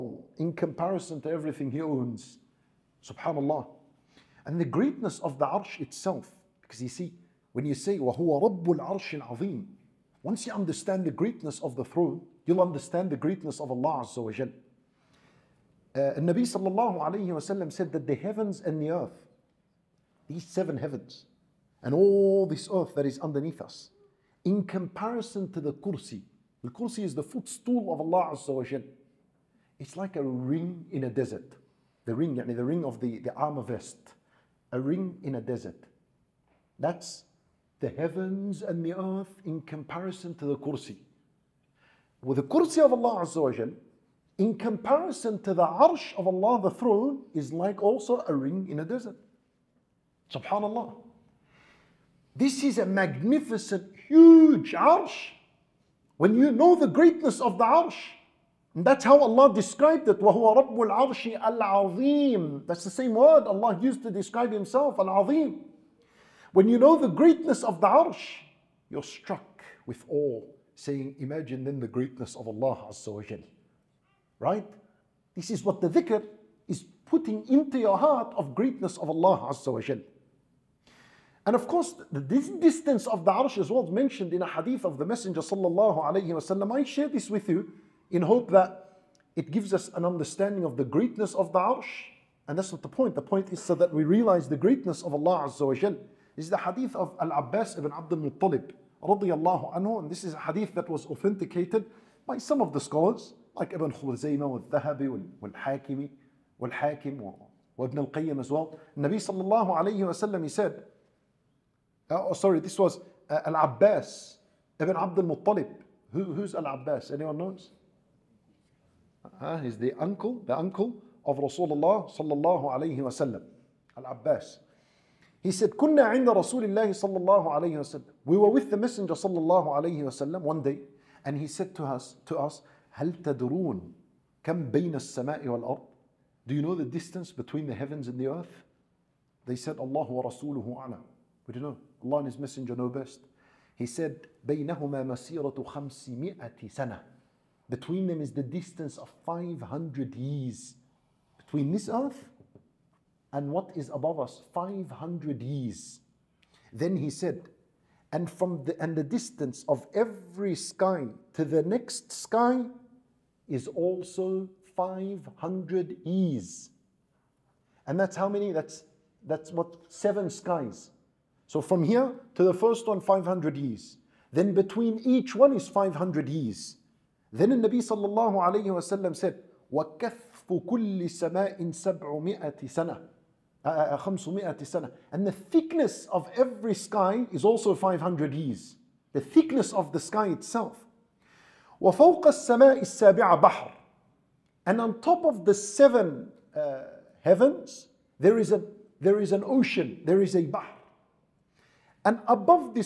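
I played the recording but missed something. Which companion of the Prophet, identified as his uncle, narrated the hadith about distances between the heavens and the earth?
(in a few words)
Al-Abbas ibn Abdul Muttalib.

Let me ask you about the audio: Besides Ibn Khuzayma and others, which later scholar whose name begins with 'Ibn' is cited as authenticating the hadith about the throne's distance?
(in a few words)
Ibn Al-Qayyim.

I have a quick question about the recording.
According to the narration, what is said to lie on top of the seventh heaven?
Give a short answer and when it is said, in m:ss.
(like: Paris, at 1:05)
An ocean, at 3:18.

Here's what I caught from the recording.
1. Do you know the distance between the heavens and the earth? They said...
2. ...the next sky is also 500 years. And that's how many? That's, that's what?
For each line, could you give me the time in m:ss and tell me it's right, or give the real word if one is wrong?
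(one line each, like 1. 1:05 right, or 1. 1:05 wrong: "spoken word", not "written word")
1. 2:16 right
2. 2:41 right.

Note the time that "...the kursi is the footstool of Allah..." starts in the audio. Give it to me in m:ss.
0:26.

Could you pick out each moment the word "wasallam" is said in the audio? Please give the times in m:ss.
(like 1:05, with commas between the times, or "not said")
0:17, 1:26, 2:02.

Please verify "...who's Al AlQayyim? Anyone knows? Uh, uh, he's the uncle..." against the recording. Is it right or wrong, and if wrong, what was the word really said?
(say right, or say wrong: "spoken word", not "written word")
wrong: "Abbas", not "AlQayyim".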